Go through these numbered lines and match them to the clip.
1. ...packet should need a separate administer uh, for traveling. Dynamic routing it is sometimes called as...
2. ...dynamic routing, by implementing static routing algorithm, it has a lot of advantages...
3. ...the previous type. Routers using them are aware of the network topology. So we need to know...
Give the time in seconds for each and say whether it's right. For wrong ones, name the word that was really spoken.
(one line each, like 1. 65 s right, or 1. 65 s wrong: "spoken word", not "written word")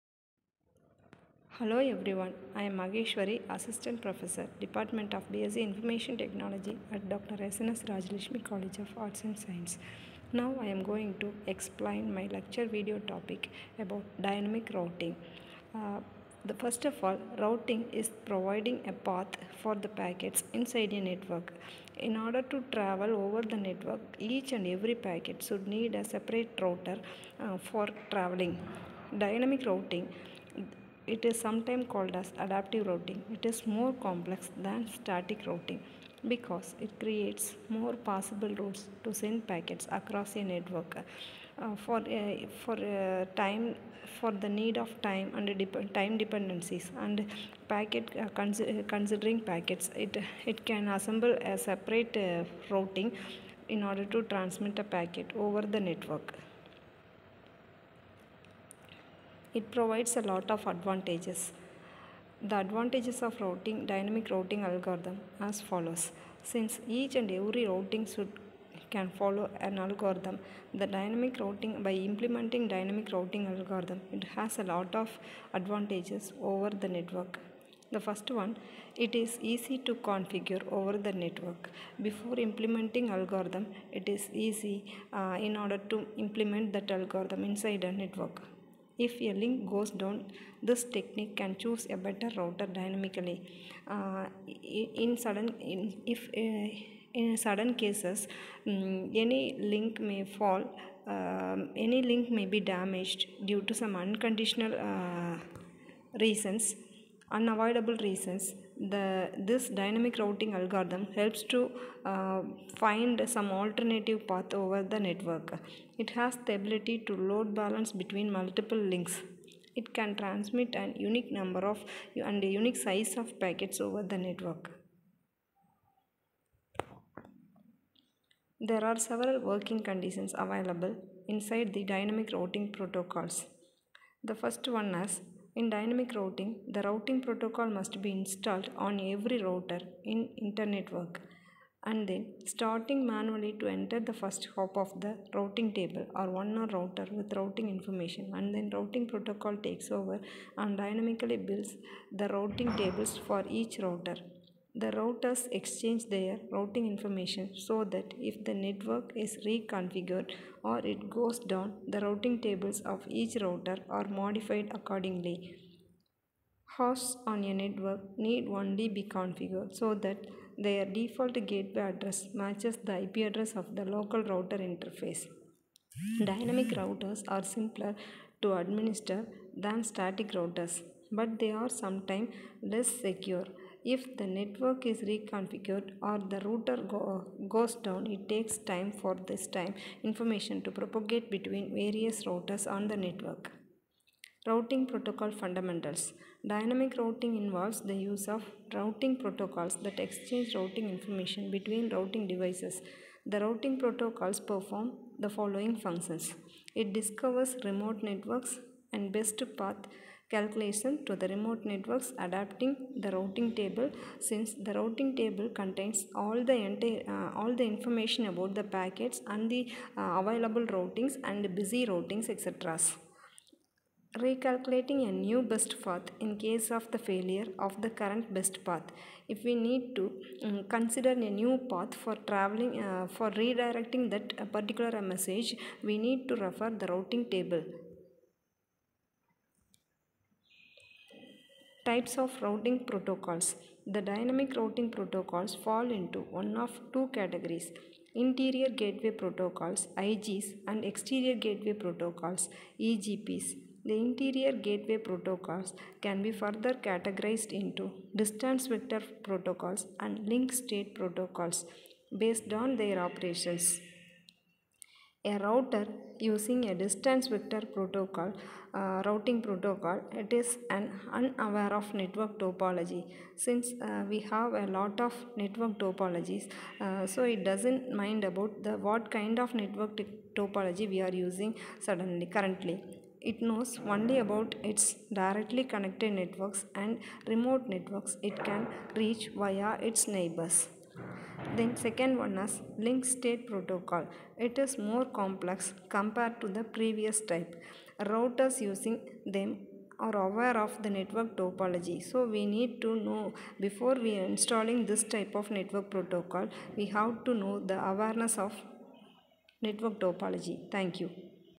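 1. 24 s wrong: "router", not "administer"
2. 70 s wrong: "dynamic", not "static"
3. 296 s right.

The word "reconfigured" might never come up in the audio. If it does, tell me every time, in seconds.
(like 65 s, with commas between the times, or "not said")
159 s, 185 s.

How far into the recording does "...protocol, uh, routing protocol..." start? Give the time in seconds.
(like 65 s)
267 s.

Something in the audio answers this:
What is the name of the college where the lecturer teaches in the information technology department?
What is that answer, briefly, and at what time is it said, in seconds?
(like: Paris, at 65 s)
Dr. SNS Rajalakshmi College of Arts and Science, at 7 s.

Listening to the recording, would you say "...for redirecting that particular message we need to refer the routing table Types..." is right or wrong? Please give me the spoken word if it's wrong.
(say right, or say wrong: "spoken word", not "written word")
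right.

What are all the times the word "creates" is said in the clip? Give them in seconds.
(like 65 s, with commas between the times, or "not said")
36 s.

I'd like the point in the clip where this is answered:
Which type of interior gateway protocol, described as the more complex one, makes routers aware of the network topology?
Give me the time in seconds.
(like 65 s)
292 s.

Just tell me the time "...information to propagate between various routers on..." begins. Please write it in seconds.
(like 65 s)
190 s.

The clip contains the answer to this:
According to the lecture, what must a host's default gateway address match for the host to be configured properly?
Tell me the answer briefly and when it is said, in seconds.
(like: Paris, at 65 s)
IP address of the local router interface, at 173 s.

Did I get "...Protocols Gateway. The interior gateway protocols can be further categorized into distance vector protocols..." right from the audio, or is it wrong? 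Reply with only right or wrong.
wrong.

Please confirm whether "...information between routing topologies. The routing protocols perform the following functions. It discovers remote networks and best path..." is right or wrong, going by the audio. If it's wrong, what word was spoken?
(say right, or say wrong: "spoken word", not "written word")
wrong: "devices", not "topologies".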